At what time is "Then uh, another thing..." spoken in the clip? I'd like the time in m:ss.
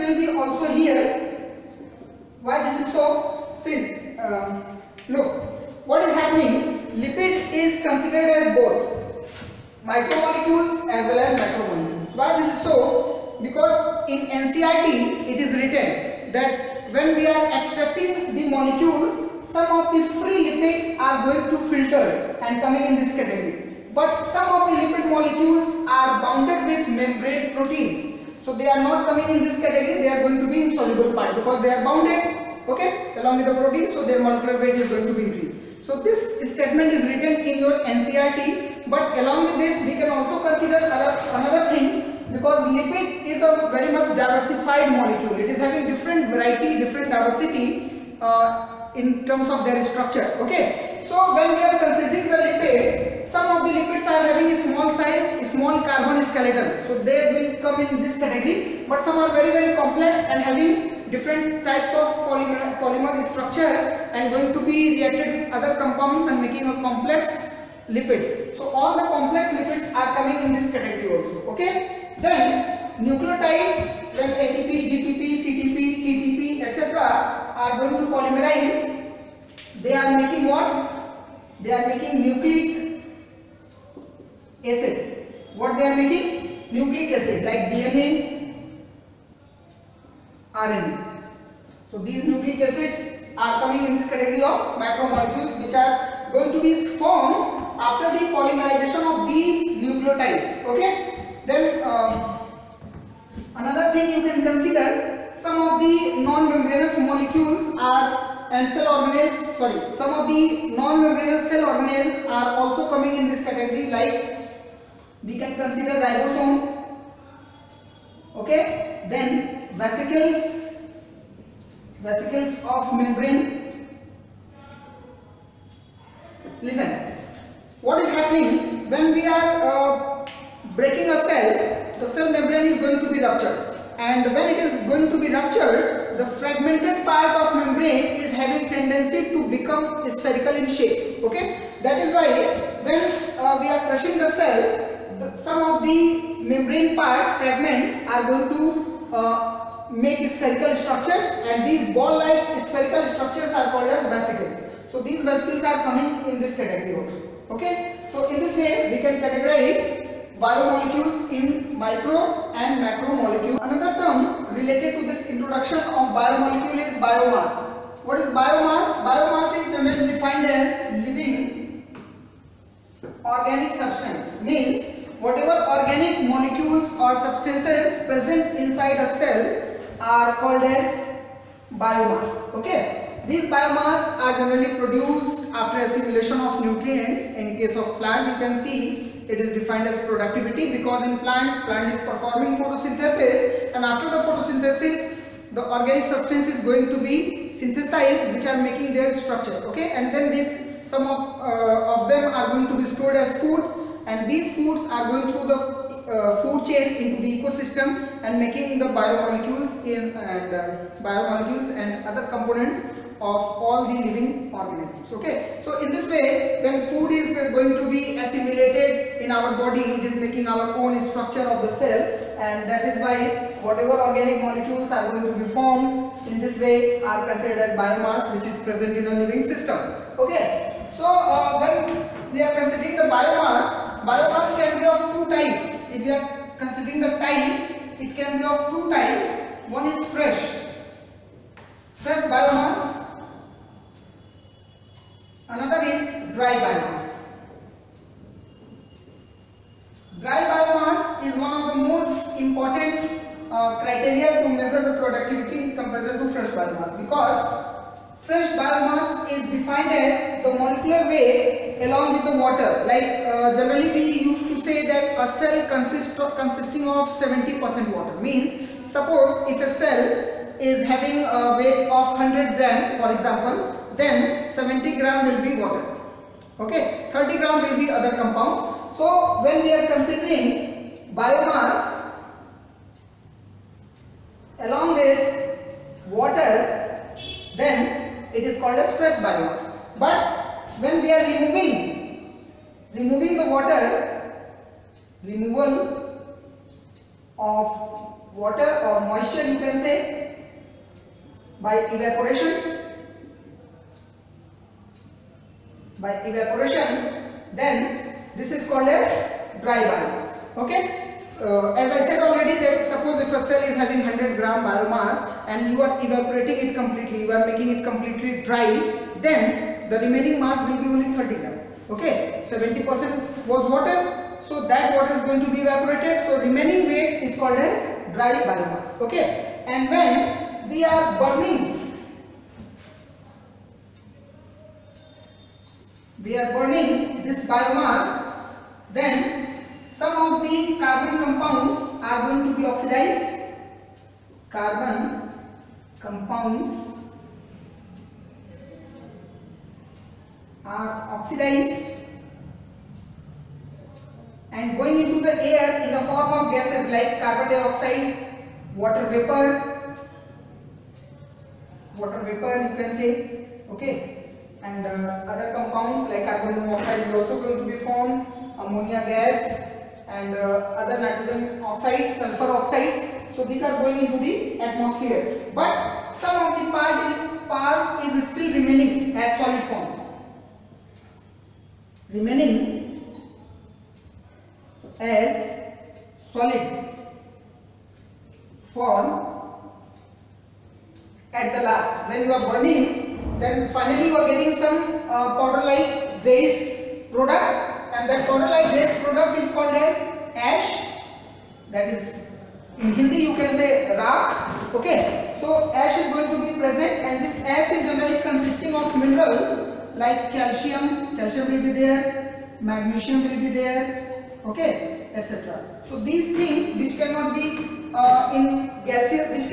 1:41.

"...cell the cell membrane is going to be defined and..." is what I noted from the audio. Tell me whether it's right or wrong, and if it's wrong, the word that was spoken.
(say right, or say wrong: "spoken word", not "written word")
wrong: "ruptured", not "defined".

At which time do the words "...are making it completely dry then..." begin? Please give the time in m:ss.
5:17.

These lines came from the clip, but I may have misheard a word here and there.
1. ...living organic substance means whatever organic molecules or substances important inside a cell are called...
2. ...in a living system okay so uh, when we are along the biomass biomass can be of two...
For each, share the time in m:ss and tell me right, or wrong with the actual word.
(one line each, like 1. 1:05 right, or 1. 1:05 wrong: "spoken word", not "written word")
1. 2:51 wrong: "present", not "important"
2. 3:48 wrong: "considering", not "along".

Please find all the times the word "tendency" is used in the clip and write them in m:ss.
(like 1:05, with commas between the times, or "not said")
2:18.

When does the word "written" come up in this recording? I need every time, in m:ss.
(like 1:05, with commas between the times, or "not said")
0:15, 0:37.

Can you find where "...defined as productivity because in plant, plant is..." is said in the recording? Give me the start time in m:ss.
3:09.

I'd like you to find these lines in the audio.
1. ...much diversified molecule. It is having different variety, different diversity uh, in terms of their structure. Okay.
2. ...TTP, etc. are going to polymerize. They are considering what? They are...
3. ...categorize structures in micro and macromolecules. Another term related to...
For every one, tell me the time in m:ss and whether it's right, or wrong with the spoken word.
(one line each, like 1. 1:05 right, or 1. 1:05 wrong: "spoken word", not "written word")
1. 0:43 right
2. 1:16 wrong: "making", not "considering"
3. 2:39 wrong: "biomolecules", not "structures".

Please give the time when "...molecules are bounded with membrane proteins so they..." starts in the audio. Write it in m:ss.
0:25.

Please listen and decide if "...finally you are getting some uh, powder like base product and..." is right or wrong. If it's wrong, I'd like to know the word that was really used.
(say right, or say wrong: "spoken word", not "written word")
right.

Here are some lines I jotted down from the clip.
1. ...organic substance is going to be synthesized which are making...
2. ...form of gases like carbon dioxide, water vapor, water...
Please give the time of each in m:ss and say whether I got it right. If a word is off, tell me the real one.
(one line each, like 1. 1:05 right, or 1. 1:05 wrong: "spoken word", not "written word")
1. 3:15 right
2. 5:56 right.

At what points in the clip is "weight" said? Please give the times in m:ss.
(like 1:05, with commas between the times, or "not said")
0:34, 4:21, 4:31, 5:26.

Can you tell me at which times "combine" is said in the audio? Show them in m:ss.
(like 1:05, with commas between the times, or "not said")
not said.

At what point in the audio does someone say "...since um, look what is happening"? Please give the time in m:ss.
0:03.